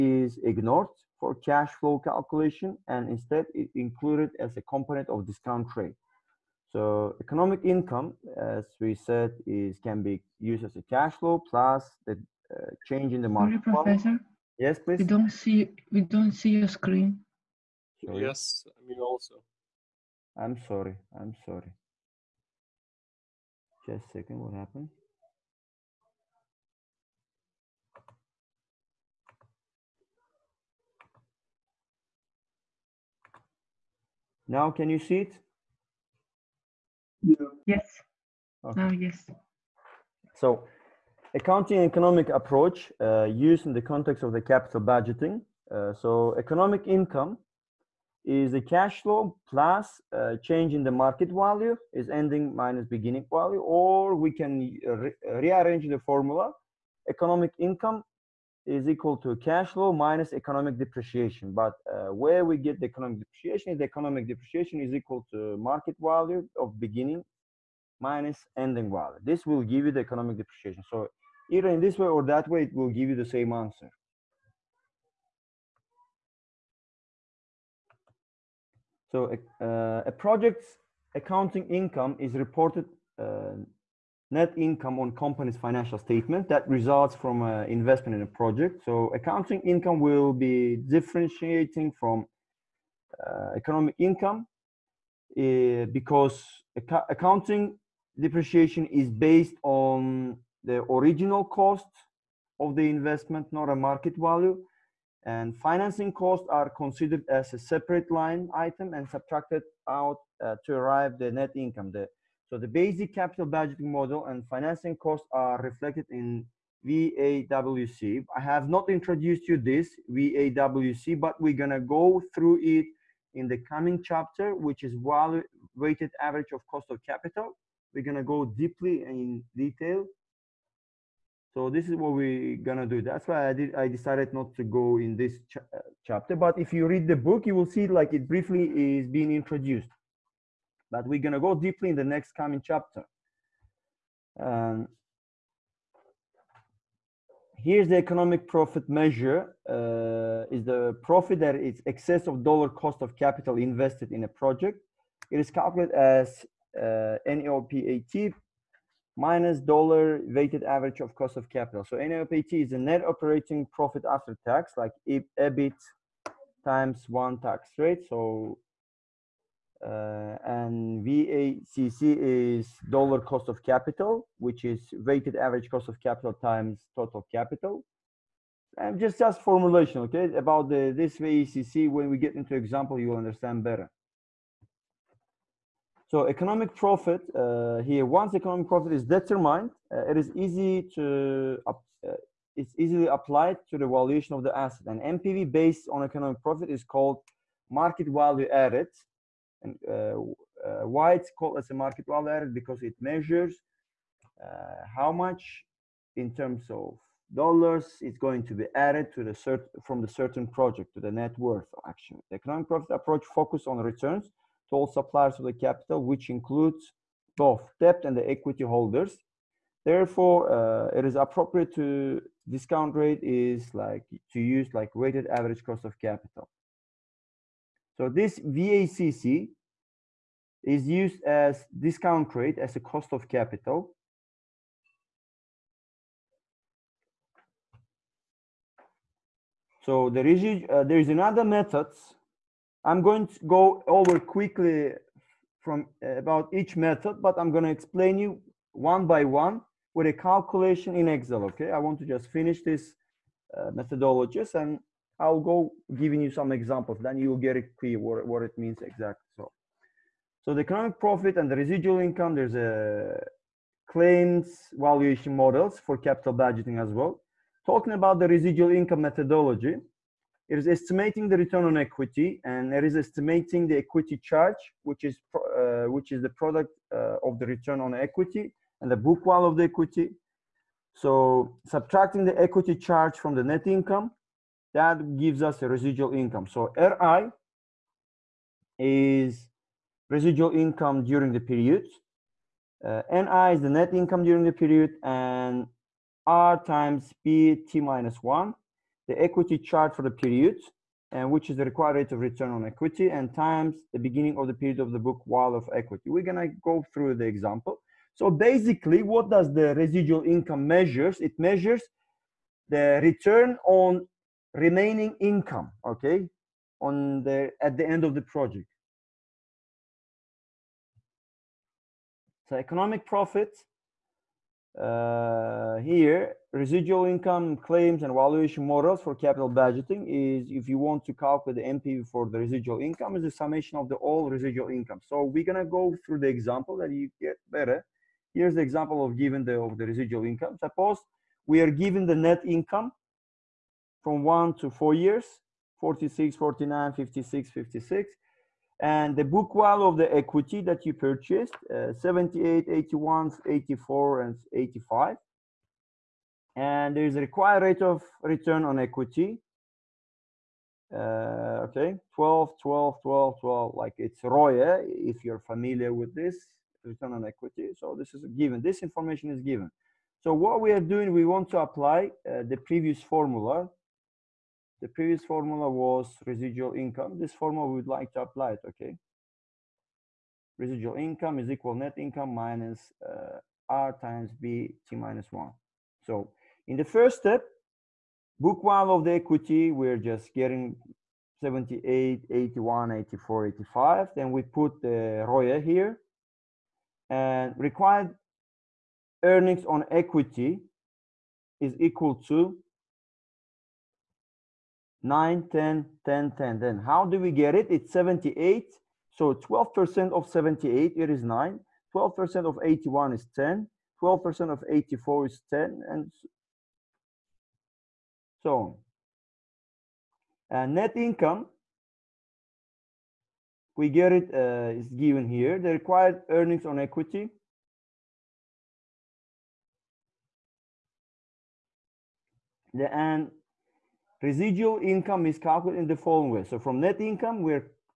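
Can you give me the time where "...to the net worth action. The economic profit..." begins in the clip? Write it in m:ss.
3:30.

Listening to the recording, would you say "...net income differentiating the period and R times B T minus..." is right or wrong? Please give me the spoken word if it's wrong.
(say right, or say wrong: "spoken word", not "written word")
wrong: "during", not "differentiating".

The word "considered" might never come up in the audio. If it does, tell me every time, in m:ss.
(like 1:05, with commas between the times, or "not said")
1:46.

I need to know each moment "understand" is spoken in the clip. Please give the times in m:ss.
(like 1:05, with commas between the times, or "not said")
3:03.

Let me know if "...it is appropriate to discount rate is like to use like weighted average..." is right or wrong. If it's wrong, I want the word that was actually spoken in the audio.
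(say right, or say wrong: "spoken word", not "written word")
right.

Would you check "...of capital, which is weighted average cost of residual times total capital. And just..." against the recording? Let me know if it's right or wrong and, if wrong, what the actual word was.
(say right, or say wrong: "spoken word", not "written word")
wrong: "capital", not "residual".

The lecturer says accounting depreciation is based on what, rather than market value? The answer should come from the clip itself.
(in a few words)
Original cost of the investment.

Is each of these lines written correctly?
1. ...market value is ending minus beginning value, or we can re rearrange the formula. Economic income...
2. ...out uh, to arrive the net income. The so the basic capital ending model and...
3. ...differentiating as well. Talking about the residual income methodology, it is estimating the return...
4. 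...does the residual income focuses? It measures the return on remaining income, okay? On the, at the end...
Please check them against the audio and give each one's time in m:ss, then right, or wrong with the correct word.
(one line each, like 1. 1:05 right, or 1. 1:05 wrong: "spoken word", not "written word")
1. 0:50 right
2. 1:49 wrong: "budgeting", not "ending"
3. 4:26 wrong: "budgeting", not "differentiating"
4. 5:09 wrong: "measures", not "focuses".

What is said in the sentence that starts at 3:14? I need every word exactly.
And NPV based on economic profit is called market value added.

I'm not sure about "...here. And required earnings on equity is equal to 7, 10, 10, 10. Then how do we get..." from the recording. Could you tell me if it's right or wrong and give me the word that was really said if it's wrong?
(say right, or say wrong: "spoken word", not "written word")
wrong: "9", not "7".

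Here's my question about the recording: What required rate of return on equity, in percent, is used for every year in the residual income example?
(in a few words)
12.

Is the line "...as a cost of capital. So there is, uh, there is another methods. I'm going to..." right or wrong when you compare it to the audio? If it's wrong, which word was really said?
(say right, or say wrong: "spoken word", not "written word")
right.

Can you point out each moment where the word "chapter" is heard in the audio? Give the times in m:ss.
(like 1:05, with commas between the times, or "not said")
2:04, 2:16, 2:22.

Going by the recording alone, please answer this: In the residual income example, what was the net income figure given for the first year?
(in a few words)
46.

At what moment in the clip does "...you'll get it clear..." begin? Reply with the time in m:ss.
4:17.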